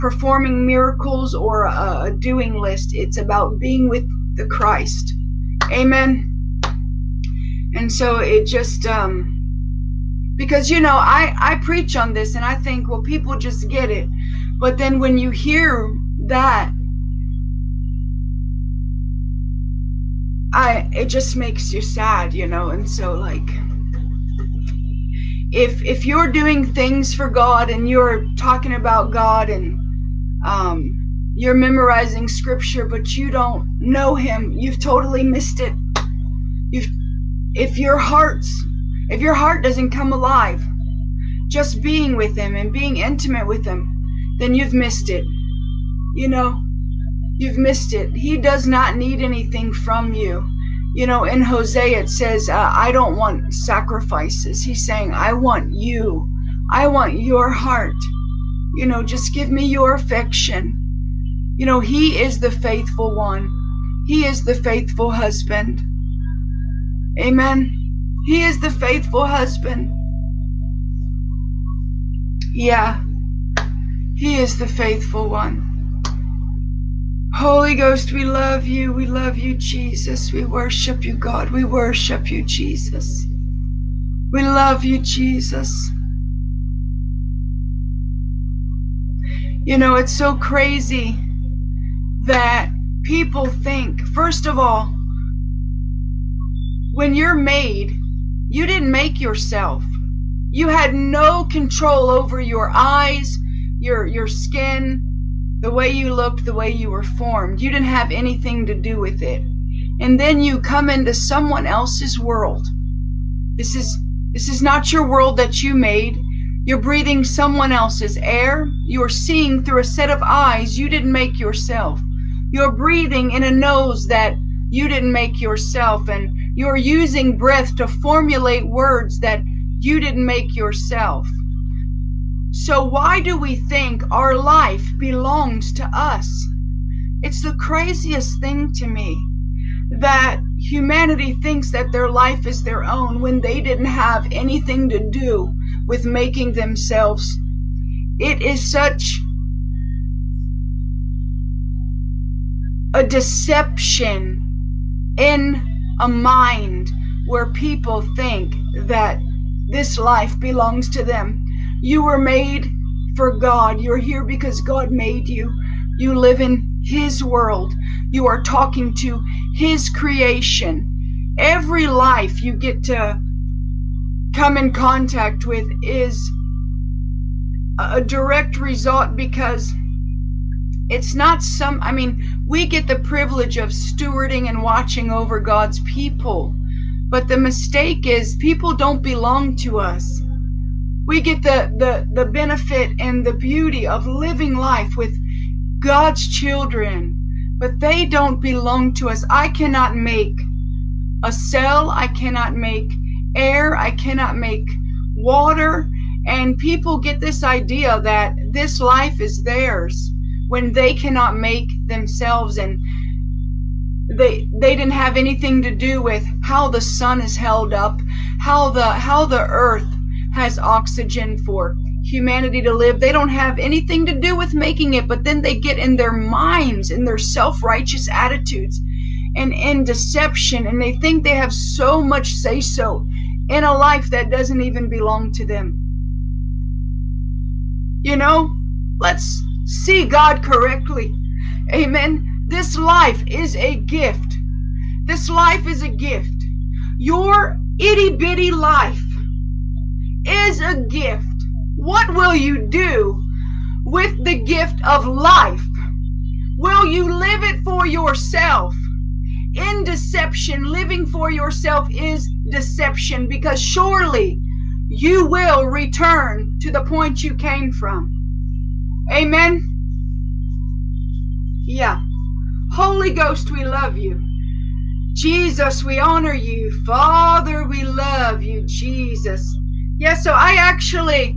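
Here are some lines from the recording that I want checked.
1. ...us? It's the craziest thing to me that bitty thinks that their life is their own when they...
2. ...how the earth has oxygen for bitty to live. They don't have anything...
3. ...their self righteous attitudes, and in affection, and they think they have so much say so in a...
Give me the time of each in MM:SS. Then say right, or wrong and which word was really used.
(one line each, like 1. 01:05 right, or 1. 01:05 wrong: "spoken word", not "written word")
1. 02:15 wrong: "humanity", not "bitty"
2. 03:38 wrong: "humanity", not "bitty"
3. 03:47 wrong: "deception", not "affection".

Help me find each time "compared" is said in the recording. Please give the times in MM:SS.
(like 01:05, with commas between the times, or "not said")
not said.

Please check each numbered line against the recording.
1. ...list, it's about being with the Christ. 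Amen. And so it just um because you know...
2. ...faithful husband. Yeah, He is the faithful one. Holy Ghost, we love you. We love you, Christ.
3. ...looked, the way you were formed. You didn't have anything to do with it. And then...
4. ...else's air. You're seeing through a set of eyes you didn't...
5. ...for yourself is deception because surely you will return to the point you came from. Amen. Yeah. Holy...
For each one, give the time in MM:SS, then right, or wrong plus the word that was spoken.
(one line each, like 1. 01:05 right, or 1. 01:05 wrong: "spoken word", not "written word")
1. 00:02 right
2. 01:08 wrong: "Jesus", not "Christ"
3. 01:46 right
4. 01:57 right
5. 04:21 right.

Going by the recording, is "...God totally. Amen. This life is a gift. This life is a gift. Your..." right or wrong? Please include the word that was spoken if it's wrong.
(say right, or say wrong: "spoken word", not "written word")
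wrong: "correctly", not "totally".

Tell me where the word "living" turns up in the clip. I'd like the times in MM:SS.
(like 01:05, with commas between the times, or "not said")
03:14, 04:20.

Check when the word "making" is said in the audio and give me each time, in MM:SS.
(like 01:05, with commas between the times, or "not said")
02:26, 03:44.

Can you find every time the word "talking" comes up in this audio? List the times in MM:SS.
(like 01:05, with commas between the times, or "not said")
00:28, 02:48.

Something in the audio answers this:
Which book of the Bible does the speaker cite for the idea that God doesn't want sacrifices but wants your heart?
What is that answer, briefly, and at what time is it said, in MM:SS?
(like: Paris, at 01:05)
Hosea, at 00:51.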